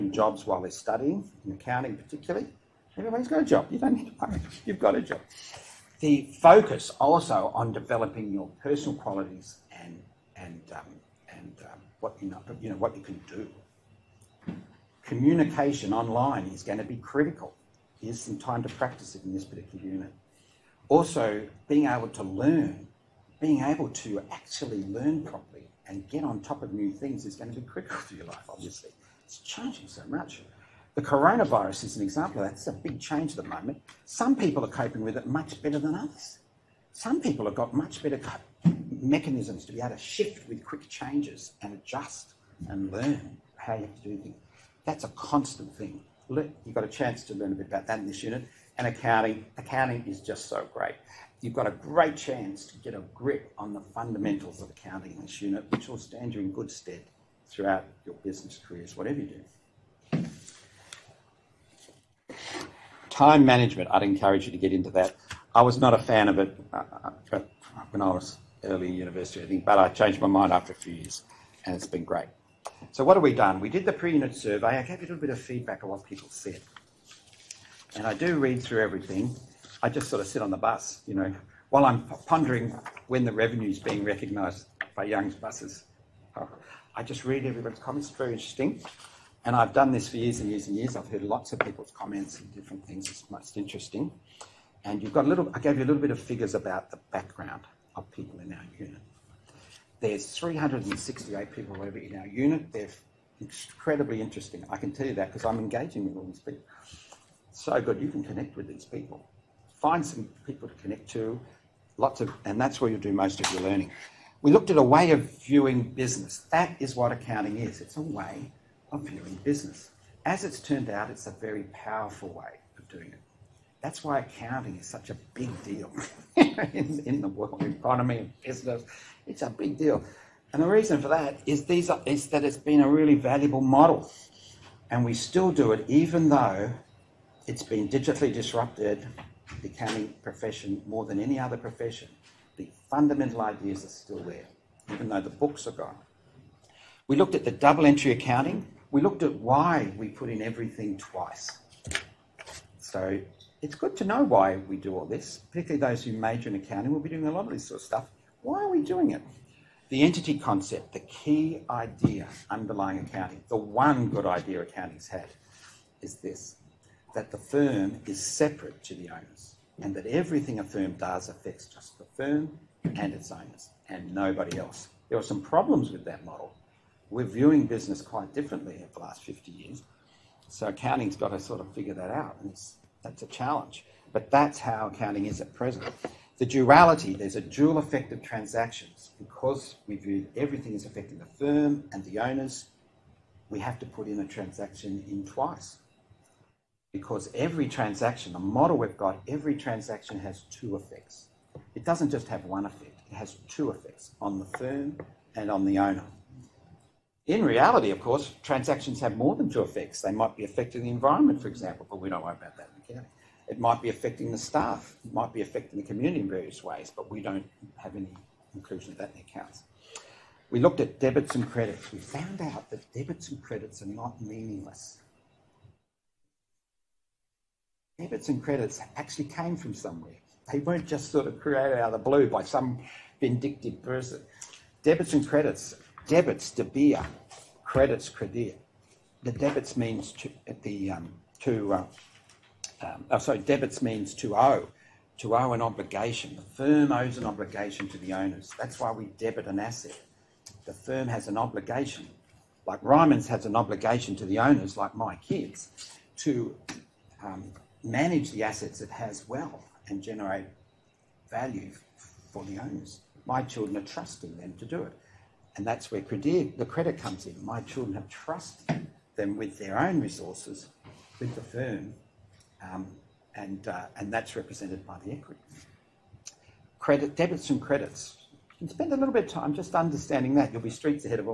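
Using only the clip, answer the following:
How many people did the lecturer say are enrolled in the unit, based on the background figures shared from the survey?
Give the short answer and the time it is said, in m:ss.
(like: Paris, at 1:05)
368, at 1:40.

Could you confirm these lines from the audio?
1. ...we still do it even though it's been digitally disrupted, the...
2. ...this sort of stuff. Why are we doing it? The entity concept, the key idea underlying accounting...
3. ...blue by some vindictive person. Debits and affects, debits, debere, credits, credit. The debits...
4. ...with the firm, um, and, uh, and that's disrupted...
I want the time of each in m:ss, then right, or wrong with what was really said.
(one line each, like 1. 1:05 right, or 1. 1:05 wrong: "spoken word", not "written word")
1. 2:15 right
2. 2:37 right
3. 3:51 wrong: "credits", not "affects"
4. 4:31 wrong: "represented", not "disrupted".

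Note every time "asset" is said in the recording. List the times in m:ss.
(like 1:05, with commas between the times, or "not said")
4:09, 4:18.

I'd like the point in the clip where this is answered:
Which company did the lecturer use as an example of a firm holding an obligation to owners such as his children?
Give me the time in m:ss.
4:12.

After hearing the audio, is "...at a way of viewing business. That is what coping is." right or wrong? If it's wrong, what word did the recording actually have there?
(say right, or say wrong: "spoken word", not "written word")
wrong: "accounting", not "coping".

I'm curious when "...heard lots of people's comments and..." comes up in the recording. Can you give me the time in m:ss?
1:31.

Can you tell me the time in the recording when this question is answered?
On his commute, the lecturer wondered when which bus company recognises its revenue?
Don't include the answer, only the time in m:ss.
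1:25.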